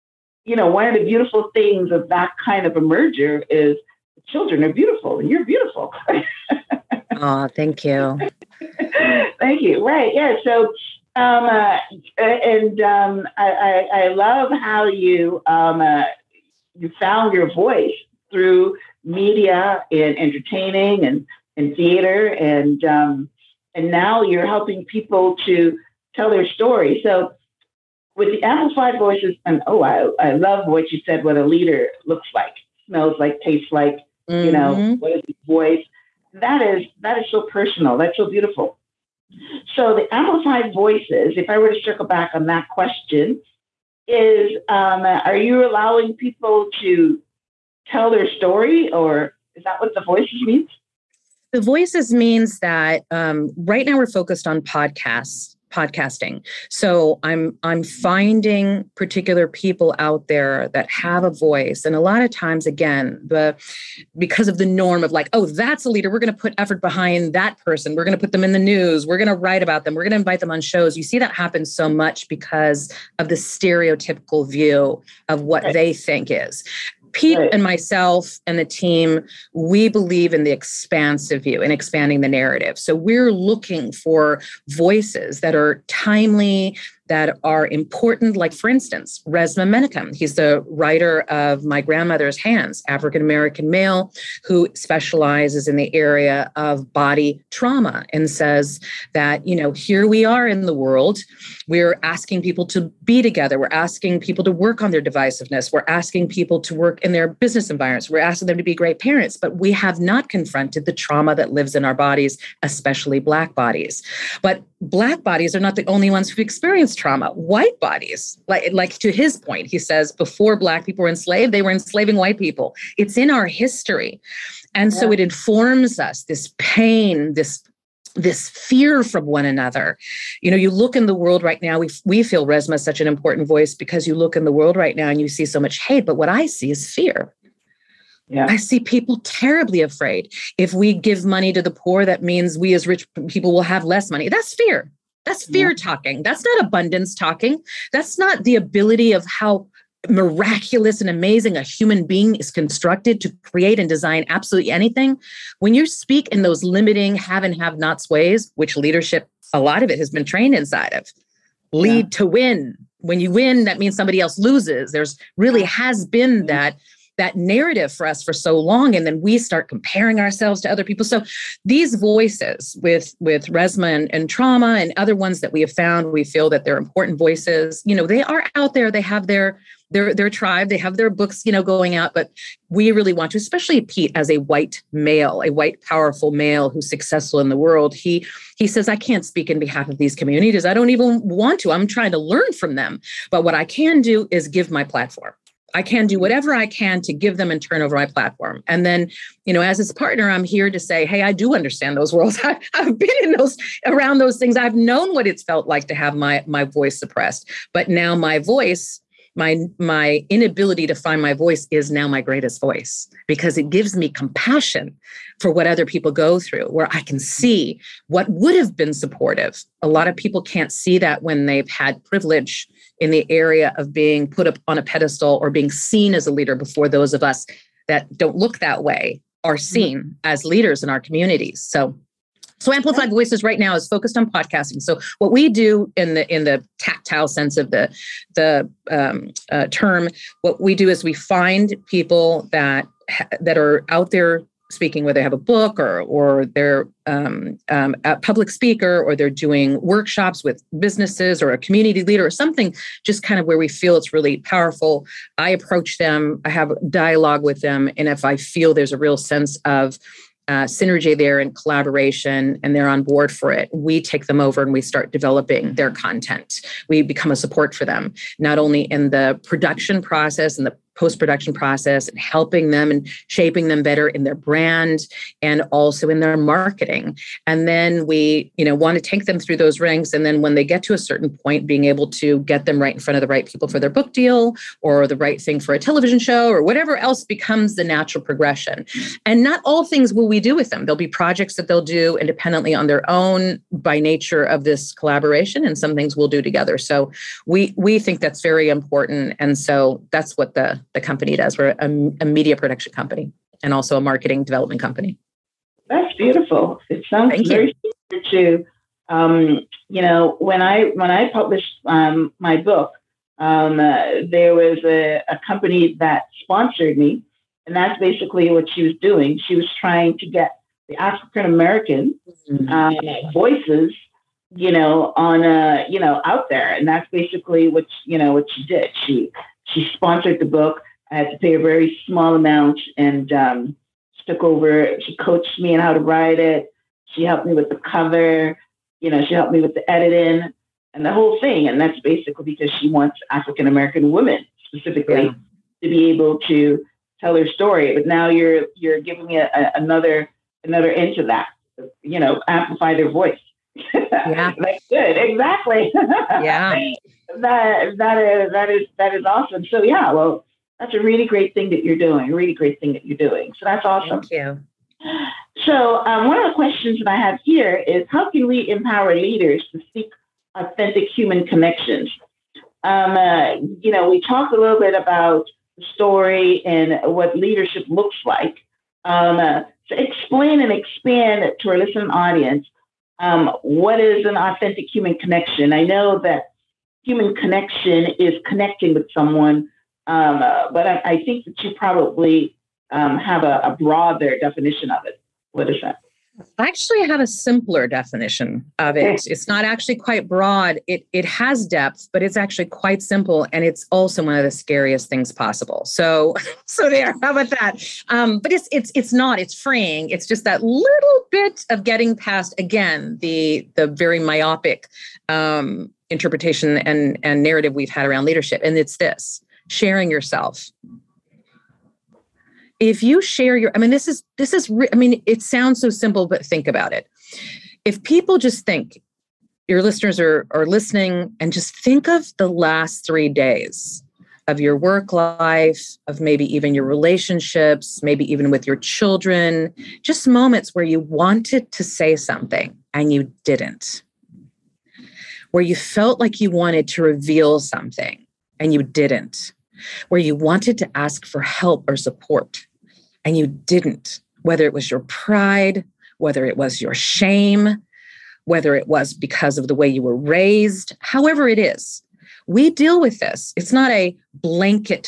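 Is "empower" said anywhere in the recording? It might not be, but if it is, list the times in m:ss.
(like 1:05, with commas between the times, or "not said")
6:08.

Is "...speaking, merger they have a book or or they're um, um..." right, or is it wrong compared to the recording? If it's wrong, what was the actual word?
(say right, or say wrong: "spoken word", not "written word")
wrong: "whether", not "merger".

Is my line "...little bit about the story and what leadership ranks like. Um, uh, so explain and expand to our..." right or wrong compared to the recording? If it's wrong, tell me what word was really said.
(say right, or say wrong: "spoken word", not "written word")
wrong: "looks", not "ranks".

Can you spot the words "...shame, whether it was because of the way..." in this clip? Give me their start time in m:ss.
7:36.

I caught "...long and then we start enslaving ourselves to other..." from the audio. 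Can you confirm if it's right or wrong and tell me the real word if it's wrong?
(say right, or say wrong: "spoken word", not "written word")
wrong: "comparing", not "enslaving".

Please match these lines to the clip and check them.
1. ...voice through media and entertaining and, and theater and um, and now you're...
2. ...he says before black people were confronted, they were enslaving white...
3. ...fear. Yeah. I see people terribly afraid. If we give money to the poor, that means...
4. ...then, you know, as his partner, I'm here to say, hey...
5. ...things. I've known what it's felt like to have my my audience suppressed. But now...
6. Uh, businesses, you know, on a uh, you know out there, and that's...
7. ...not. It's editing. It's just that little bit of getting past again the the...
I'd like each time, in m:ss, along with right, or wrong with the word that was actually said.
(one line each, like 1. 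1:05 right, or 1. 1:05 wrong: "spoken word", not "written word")
1. 0:17 right
2. 1:59 wrong: "enslaved", not "confronted"
3. 2:16 right
4. 3:18 right
5. 3:24 wrong: "voice", not "audience"
6. 5:22 wrong: "voices", not "businesses"
7. 6:49 wrong: "freeing", not "editing".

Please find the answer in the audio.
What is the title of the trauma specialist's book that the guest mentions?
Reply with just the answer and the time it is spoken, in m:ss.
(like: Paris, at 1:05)
My Grandmother's Hands, at 1:31.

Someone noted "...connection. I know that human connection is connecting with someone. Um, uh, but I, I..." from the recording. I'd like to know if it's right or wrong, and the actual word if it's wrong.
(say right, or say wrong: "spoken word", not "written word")
right.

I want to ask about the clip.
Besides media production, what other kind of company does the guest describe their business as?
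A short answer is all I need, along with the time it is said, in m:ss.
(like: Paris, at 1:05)
marketing development company, at 5:04.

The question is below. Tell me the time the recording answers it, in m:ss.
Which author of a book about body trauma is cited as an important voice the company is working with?
1:29.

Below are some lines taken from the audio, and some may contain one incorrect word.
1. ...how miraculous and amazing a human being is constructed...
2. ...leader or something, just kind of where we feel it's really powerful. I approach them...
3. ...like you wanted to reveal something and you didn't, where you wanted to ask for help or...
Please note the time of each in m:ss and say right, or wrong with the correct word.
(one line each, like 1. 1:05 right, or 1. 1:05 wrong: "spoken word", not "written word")
1. 2:29 right
2. 4:12 right
3. 7:26 right.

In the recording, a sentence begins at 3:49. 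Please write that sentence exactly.
seen as leaders in our communities so so Amplified oh.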